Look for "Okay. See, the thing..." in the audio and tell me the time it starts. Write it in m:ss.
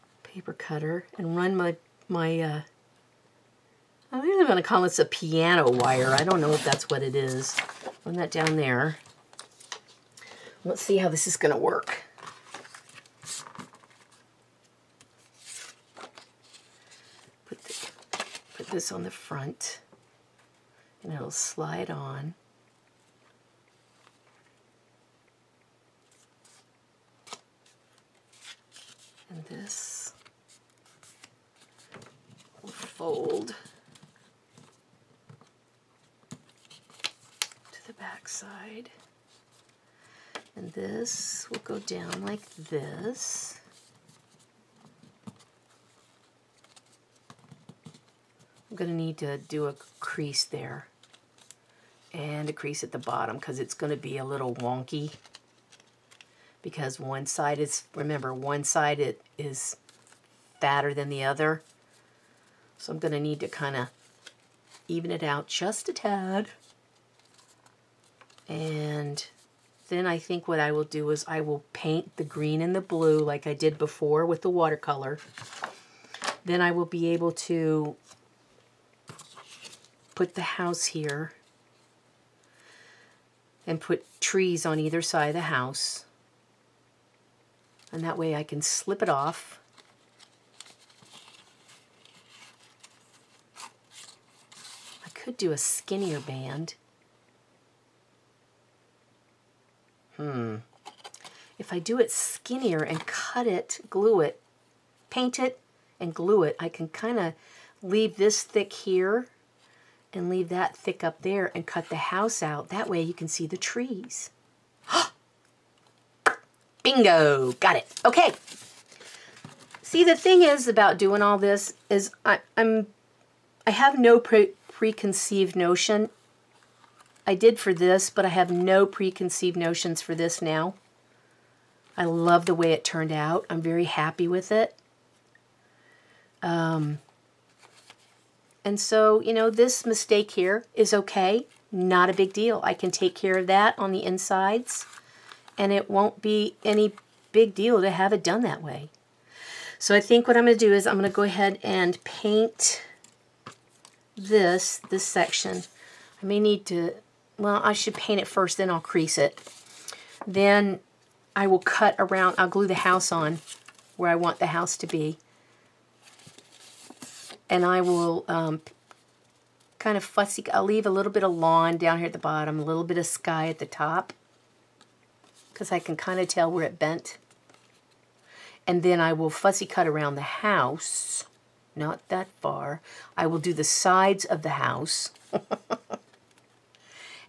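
1:58.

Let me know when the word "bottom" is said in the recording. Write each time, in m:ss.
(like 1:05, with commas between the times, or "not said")
0:52, 2:52.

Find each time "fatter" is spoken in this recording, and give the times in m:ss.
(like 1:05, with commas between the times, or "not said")
1:00.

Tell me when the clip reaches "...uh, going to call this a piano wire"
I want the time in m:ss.
0:02.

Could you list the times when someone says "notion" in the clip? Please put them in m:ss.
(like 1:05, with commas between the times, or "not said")
2:05, 2:09.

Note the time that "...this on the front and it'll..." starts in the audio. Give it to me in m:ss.
0:18.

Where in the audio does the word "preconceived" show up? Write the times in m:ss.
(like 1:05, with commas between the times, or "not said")
2:04, 2:08.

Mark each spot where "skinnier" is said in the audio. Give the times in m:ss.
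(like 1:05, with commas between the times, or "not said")
1:35, 1:42.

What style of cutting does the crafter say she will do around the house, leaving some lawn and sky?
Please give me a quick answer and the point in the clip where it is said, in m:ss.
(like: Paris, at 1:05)
fussy cut, at 2:59.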